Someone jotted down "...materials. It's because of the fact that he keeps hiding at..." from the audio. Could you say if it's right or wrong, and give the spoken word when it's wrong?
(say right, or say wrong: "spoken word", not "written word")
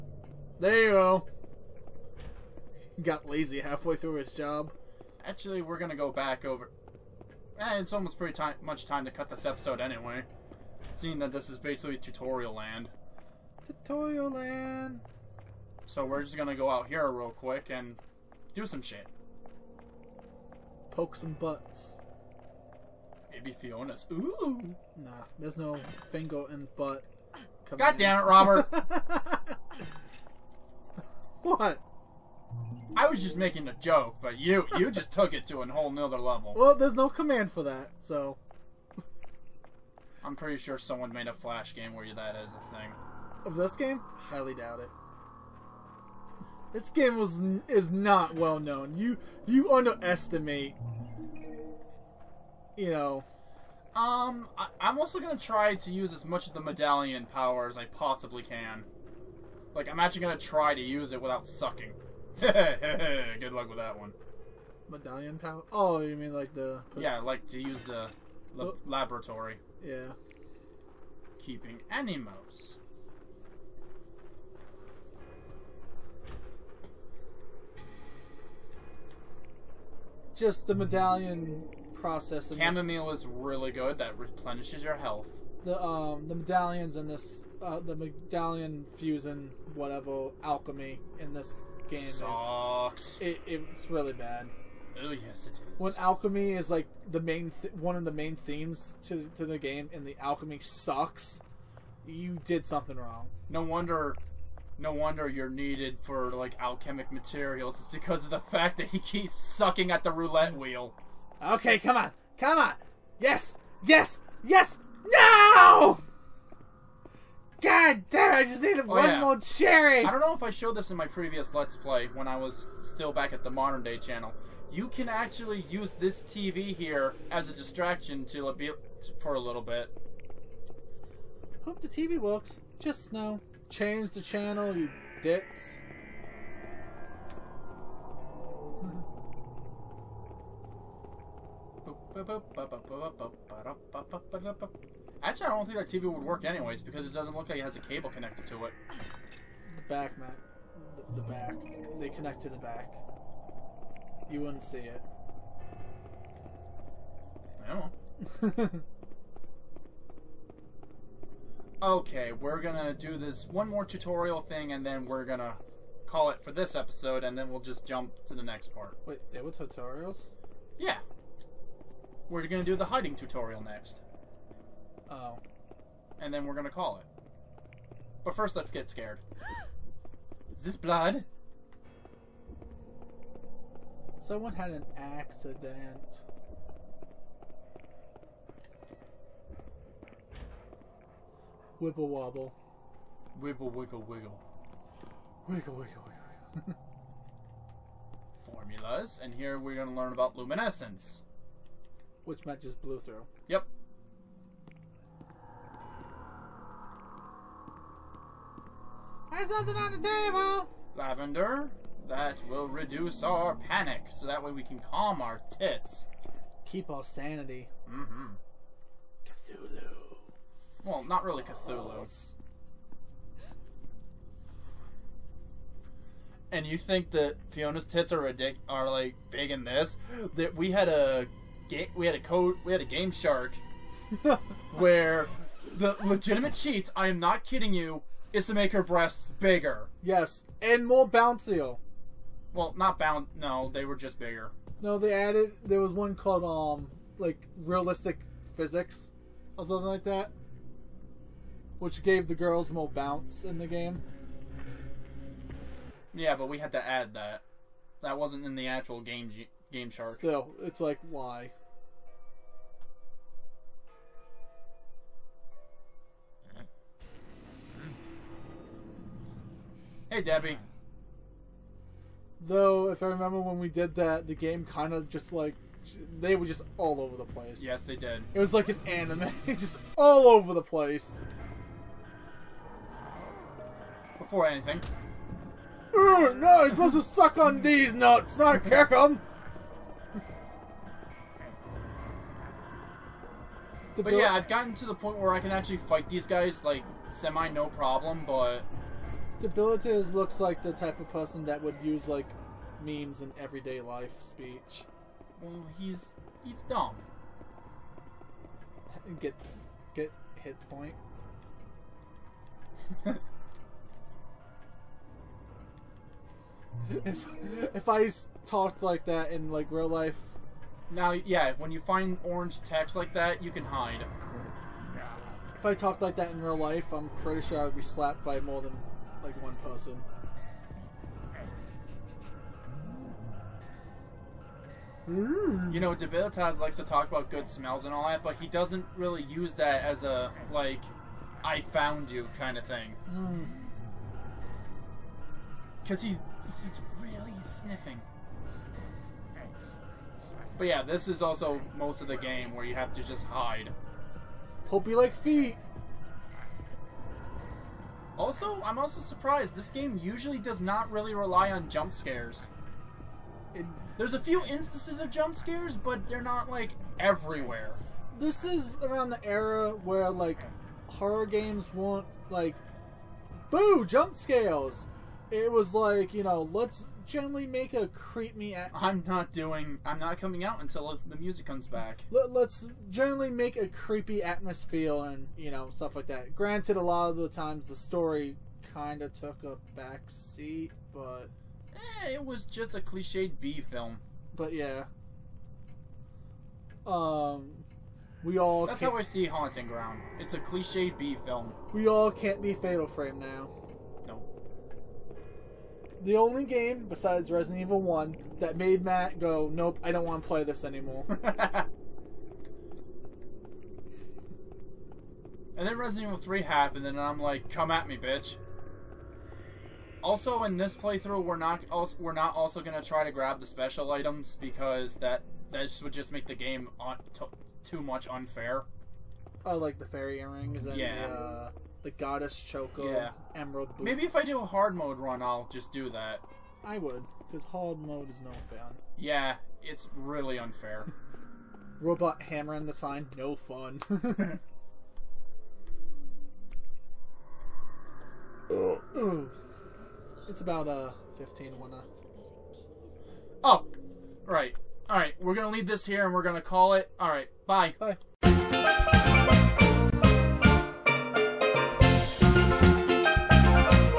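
wrong: "sucking", not "hiding".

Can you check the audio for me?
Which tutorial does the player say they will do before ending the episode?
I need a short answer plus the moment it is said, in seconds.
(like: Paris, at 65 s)
hiding tutorial, at 172 s.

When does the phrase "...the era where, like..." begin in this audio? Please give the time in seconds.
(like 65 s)
369 s.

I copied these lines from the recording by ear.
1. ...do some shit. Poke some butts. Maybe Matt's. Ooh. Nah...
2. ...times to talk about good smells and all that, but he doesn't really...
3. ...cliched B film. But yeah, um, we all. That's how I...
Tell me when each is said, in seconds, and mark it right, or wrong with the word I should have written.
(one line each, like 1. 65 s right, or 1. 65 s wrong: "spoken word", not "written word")
1. 18 s wrong: "Fiona", not "Matt"
2. 336 s wrong: "likes", not "times"
3. 392 s right.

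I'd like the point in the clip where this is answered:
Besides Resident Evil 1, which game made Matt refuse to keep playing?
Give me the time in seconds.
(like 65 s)
402 s.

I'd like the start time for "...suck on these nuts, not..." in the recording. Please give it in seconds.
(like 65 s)
287 s.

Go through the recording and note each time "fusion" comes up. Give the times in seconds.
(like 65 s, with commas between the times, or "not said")
88 s.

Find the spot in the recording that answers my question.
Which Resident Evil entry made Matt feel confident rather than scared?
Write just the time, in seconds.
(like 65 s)
415 s.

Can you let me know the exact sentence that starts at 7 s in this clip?
Eh, it's almost pretty time, much time to cut this episode anyway.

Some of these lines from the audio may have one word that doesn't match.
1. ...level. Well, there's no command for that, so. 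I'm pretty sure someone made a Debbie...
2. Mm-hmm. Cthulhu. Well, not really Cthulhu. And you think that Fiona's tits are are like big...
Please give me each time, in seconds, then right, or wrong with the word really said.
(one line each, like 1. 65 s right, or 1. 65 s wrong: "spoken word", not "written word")
1. 36 s wrong: "Flash", not "Debbie"
2. 217 s right.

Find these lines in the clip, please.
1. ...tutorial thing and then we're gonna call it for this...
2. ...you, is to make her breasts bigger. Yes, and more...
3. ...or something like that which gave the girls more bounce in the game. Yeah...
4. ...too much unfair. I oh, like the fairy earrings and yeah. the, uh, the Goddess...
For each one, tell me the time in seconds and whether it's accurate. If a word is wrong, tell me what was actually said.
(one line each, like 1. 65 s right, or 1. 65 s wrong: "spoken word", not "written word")
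1. 163 s right
2. 237 s right
3. 249 s right
4. 427 s right.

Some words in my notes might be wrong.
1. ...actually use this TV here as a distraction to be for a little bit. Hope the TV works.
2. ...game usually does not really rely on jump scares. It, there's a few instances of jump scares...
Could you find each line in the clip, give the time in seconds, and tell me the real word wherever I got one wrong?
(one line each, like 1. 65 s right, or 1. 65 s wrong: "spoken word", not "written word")
1. 125 s right
2. 359 s right.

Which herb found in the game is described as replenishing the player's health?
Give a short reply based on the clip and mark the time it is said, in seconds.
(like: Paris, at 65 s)
Chamomile, at 82 s.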